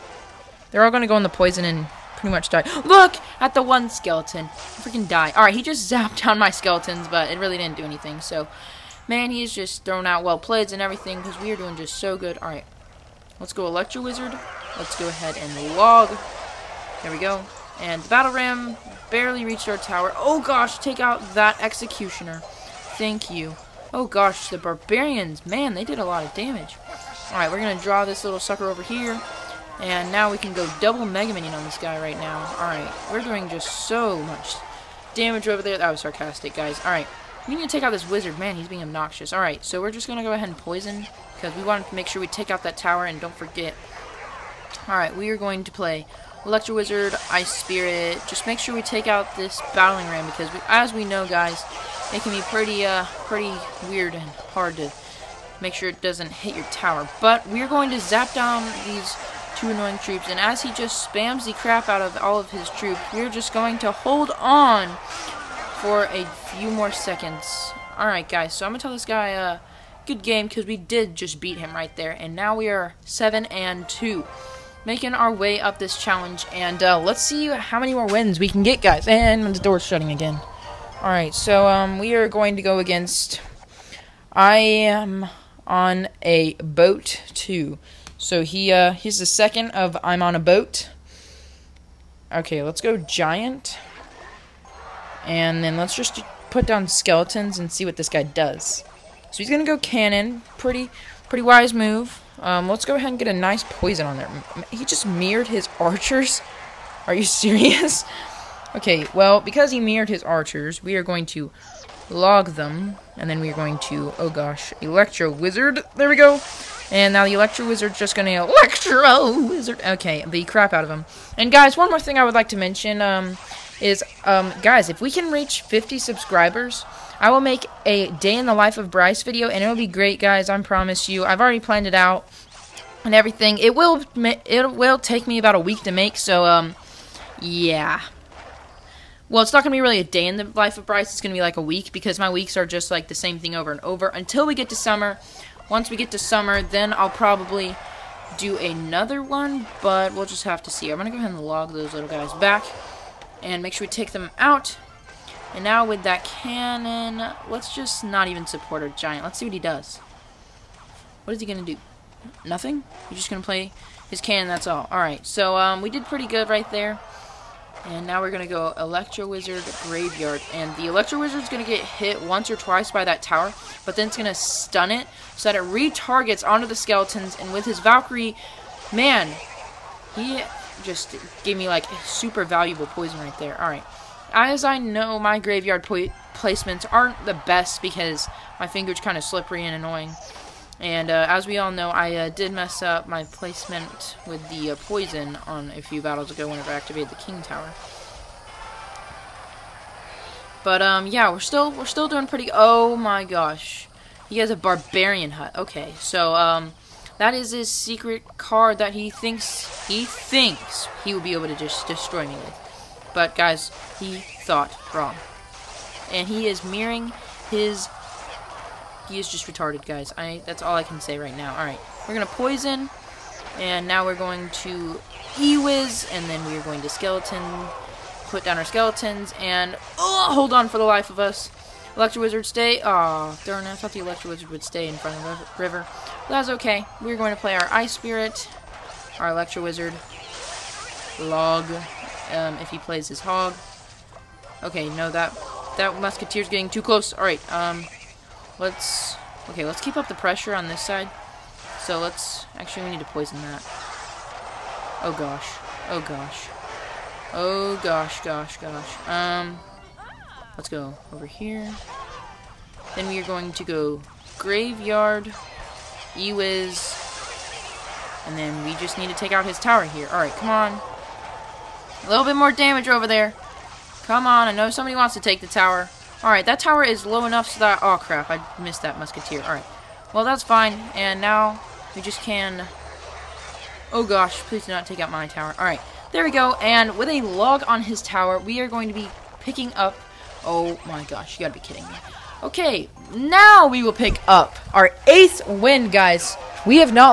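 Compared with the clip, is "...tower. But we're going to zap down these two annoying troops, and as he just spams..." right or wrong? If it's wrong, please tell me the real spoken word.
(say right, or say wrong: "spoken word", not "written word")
right.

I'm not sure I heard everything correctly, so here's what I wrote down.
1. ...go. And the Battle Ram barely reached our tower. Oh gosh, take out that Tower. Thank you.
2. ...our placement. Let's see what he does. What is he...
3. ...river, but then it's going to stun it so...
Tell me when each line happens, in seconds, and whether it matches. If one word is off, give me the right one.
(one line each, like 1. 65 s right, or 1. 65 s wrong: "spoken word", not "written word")
1. 17 s wrong: "Executioner", not "Tower"
2. 158 s wrong: "giant", not "placement"
3. 173 s wrong: "tower", not "river".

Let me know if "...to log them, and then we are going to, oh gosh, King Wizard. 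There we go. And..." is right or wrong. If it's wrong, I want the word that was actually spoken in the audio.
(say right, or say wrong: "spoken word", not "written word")
wrong: "Electro", not "King".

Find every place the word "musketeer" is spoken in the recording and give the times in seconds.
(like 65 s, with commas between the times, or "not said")
246 s, 278 s.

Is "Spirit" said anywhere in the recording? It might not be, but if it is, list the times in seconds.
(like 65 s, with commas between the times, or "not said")
47 s, 237 s.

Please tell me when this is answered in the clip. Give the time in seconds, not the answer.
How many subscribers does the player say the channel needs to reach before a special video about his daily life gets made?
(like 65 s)
125 s.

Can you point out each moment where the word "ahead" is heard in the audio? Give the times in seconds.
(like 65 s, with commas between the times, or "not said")
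15 s, 40 s, 102 s, 151 s.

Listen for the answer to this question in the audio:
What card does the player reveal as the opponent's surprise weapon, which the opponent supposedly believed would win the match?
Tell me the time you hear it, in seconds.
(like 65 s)
204 s.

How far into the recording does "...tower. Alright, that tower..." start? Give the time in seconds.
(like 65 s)
275 s.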